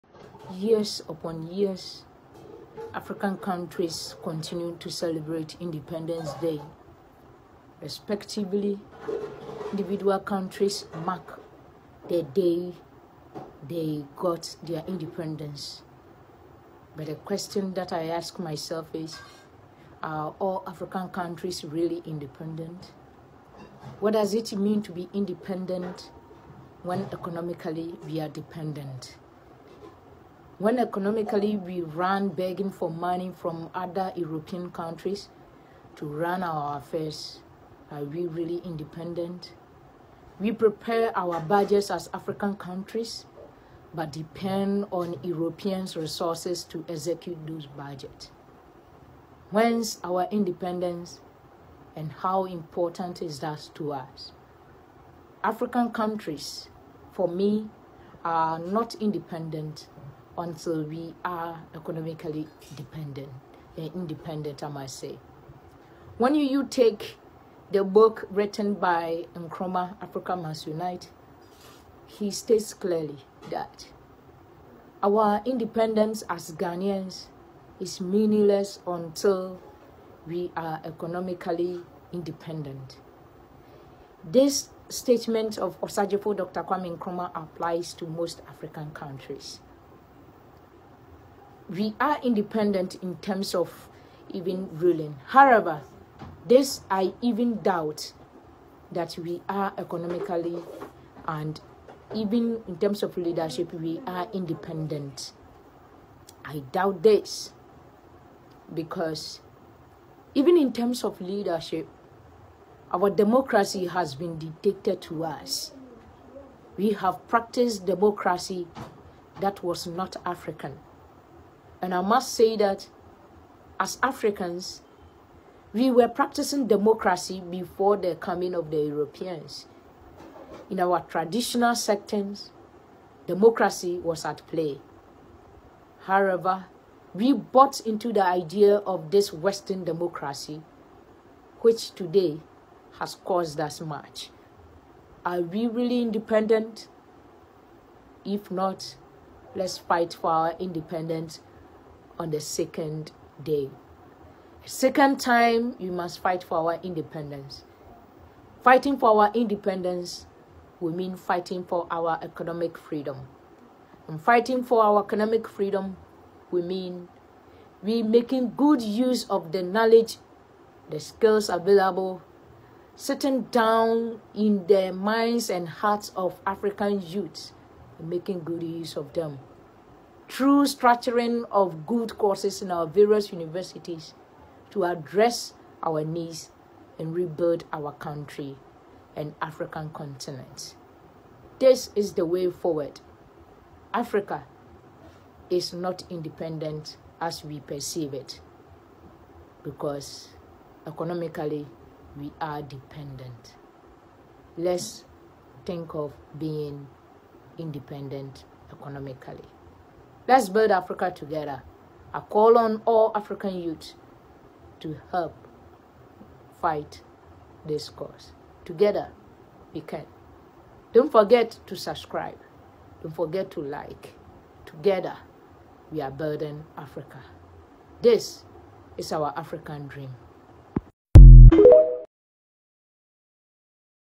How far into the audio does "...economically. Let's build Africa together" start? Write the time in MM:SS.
03:28.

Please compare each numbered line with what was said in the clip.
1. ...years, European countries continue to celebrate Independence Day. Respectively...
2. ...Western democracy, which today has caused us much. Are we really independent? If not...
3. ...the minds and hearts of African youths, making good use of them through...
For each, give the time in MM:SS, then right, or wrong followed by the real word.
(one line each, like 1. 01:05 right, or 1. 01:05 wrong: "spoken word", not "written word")
1. 00:01 wrong: "African", not "European"
2. 02:19 right
3. 02:54 right.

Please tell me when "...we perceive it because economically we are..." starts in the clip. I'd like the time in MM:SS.
03:17.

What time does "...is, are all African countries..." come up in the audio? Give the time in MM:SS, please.
00:18.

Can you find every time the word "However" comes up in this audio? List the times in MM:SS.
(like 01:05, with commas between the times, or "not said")
01:35, 02:16.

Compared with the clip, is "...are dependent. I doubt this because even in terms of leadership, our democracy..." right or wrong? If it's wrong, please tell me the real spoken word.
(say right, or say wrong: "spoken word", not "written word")
wrong: "independent", not "dependent".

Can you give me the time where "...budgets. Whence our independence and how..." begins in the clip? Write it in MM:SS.
00:47.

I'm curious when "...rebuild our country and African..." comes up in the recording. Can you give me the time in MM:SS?
03:07.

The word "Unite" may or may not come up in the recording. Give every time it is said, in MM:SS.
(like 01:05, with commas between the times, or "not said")
01:10.